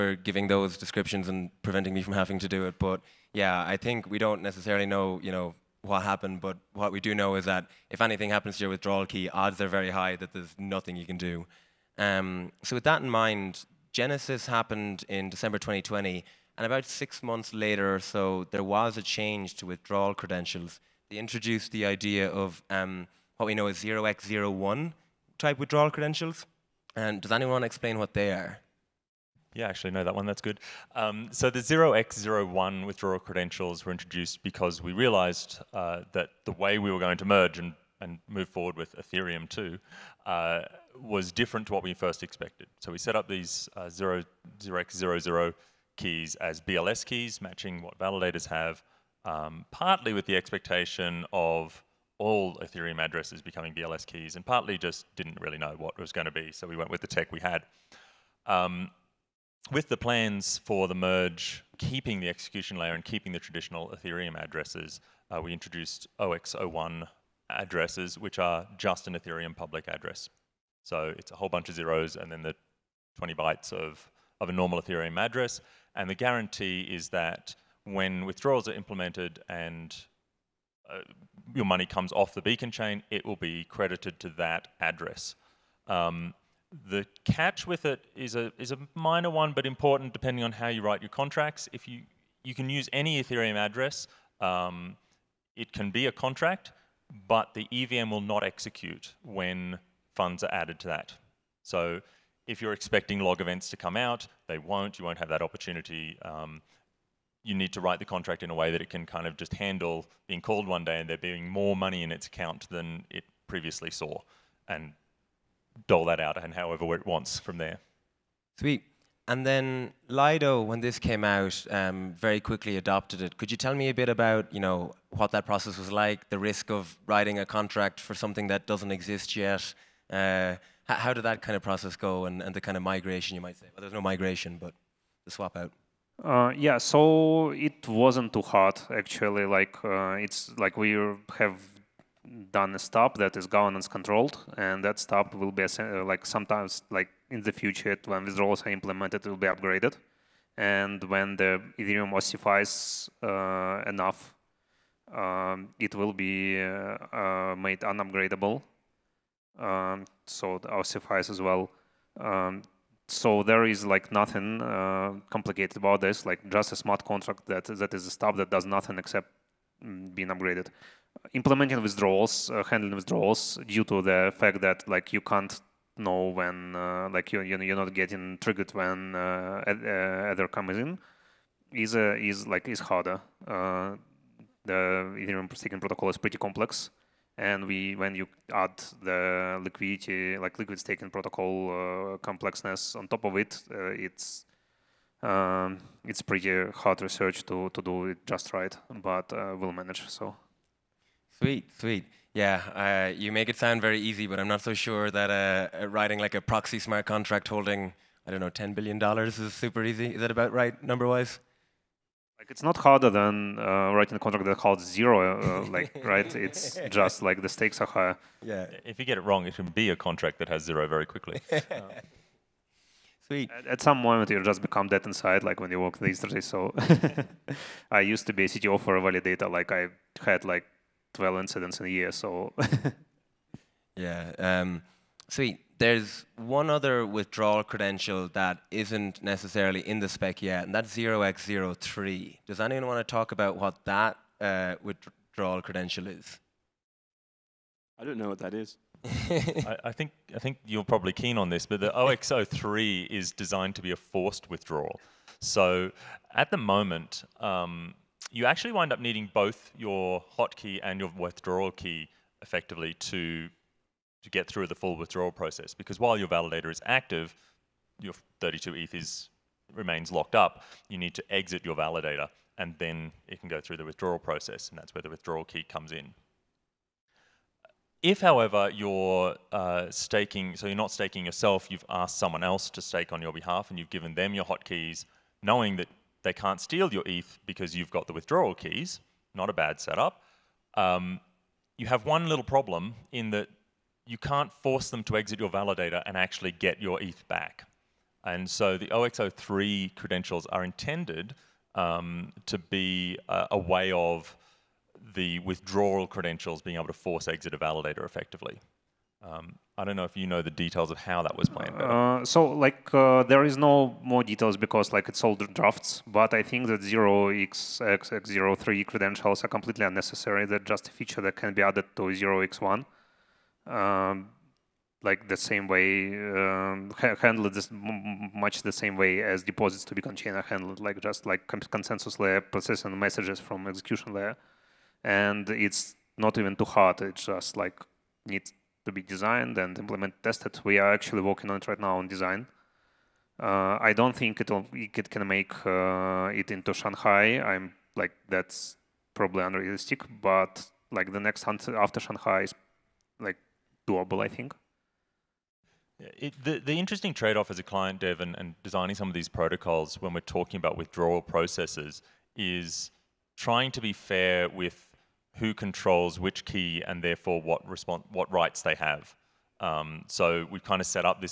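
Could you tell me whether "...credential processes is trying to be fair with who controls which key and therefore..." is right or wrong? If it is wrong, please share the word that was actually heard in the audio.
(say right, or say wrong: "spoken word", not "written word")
wrong: "withdrawal", not "credential".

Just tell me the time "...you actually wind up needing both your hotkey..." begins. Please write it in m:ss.
4:18.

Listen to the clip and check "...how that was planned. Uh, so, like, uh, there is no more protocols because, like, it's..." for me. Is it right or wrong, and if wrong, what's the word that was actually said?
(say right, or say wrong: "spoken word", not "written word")
wrong: "details", not "protocols".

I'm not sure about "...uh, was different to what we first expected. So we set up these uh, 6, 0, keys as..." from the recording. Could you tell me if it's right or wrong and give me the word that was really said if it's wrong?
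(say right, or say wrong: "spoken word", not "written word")
wrong: "0", not "6".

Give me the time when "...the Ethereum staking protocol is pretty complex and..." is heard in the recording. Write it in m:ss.
3:04.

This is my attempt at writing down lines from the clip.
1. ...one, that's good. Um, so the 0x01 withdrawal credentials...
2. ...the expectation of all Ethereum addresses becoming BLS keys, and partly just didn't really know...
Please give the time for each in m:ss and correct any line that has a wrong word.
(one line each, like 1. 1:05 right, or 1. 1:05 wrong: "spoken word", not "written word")
1. 0:30 right
2. 0:50 right.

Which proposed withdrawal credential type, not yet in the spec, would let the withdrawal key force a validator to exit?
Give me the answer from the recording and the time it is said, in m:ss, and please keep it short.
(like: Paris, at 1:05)
0x03, at 4:00.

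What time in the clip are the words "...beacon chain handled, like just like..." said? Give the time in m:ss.
5:29.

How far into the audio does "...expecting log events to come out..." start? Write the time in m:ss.
1:42.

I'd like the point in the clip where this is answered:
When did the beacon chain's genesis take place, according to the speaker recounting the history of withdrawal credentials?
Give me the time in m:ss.
0:15.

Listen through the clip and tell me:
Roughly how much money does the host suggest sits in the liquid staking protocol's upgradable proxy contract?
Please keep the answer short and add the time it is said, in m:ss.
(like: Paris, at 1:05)
10 billion dollars, at 3:28.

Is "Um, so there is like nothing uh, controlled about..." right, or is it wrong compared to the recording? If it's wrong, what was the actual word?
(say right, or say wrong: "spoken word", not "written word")
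wrong: "complicated", not "controlled".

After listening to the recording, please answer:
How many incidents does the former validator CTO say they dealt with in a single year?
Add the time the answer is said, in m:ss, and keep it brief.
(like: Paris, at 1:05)
12, at 3:51.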